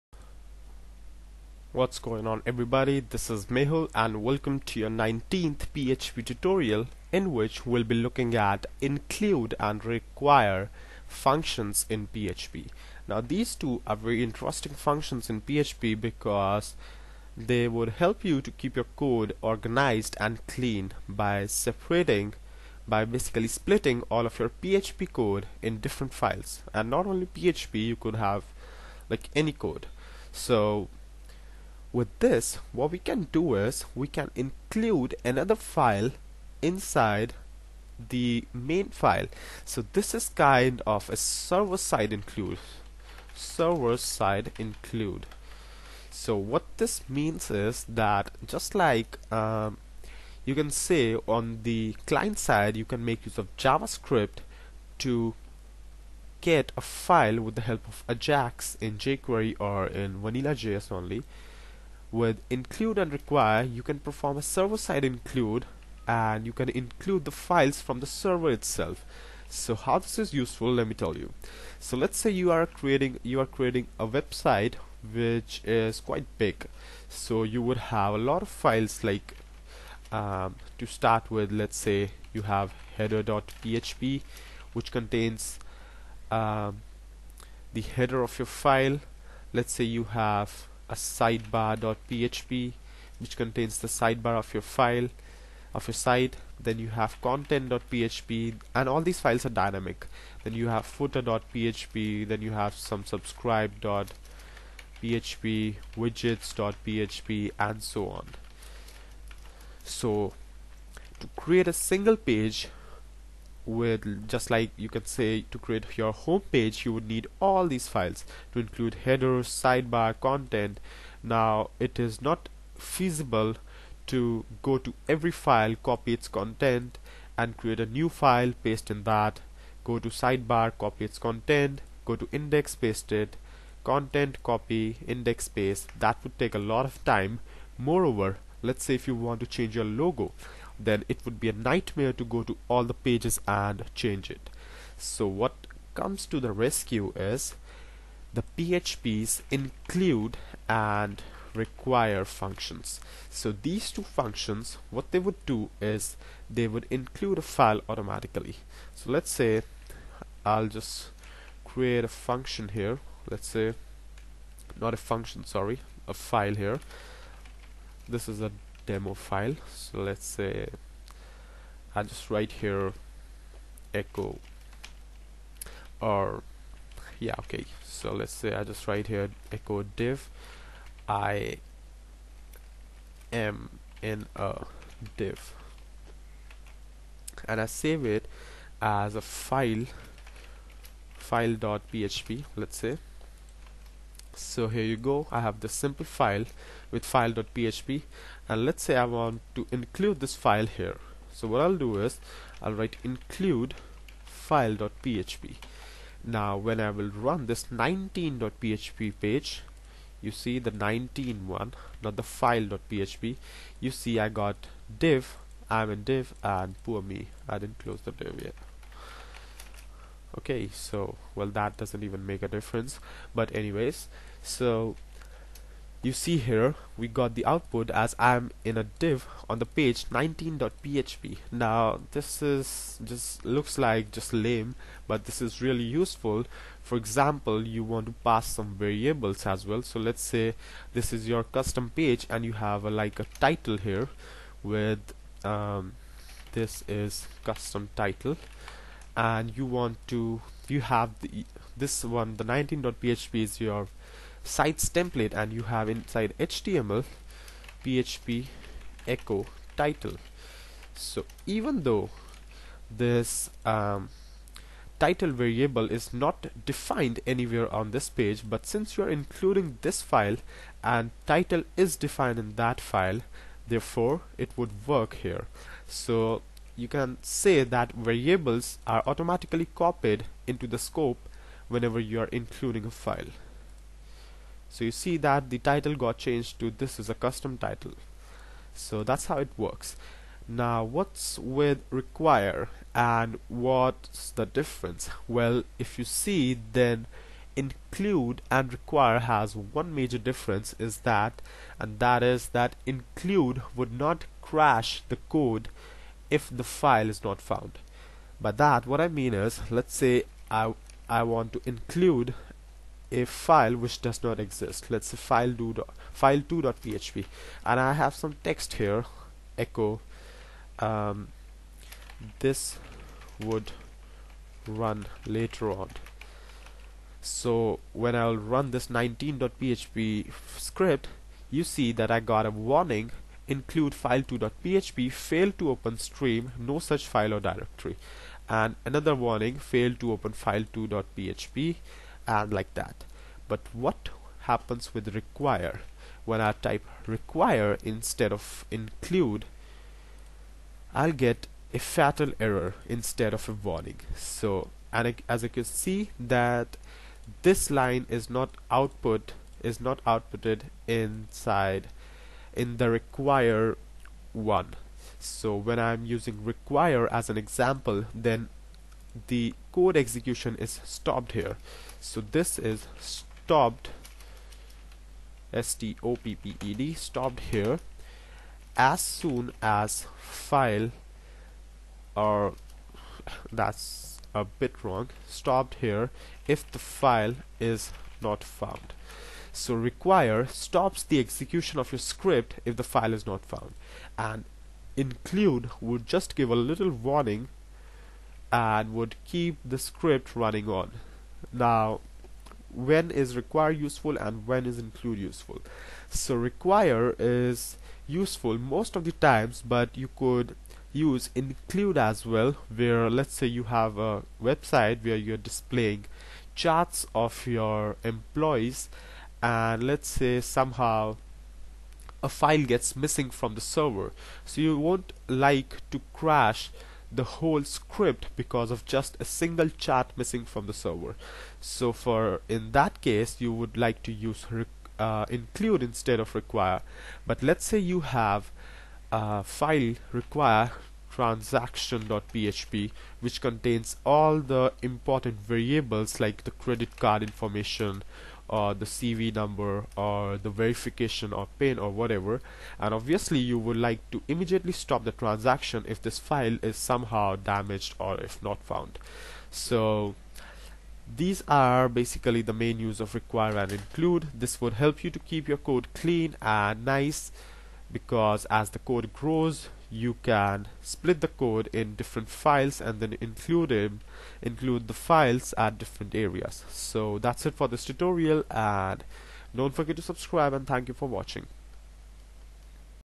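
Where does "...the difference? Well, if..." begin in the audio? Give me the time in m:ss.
4:54.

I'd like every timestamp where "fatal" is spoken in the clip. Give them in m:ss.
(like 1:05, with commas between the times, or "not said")
5:51.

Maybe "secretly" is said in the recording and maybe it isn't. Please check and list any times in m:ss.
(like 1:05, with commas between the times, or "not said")
not said.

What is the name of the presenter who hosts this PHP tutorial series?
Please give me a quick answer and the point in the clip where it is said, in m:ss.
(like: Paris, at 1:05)
Mehul, at 0:03.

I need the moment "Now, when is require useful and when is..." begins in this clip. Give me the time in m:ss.
6:41.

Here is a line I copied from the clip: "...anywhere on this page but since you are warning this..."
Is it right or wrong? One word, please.
wrong.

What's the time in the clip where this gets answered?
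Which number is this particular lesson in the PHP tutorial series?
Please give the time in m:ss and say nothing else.
0:04.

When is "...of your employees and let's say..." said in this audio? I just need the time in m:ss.
6:57.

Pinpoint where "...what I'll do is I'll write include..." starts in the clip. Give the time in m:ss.
3:21.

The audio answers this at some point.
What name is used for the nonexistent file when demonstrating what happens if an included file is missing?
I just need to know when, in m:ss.
5:16.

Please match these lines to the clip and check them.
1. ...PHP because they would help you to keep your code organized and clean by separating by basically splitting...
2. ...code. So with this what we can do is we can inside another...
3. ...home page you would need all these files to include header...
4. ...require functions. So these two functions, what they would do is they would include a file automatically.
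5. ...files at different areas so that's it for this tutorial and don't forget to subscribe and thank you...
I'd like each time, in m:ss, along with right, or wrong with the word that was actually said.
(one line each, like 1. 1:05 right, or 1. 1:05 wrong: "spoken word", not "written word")
1. 0:15 right
2. 0:29 wrong: "include", not "inside"
3. 1:56 right
4. 2:31 right
5. 7:54 right.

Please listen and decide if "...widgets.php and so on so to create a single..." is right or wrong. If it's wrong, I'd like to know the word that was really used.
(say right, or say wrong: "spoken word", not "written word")
right.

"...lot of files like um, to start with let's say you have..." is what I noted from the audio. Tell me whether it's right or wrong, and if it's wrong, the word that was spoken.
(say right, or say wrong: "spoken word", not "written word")
right.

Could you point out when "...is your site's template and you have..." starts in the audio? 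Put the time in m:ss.
4:13.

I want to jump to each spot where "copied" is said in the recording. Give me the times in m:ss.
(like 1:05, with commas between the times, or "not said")
4:39.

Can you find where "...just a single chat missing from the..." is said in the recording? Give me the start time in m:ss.
7:08.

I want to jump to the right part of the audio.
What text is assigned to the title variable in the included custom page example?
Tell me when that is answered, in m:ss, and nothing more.
4:06.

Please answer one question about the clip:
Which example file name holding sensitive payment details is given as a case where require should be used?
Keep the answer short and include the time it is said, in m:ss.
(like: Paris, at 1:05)
transaction.php, at 7:21.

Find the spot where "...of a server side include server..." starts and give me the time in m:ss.
0:40.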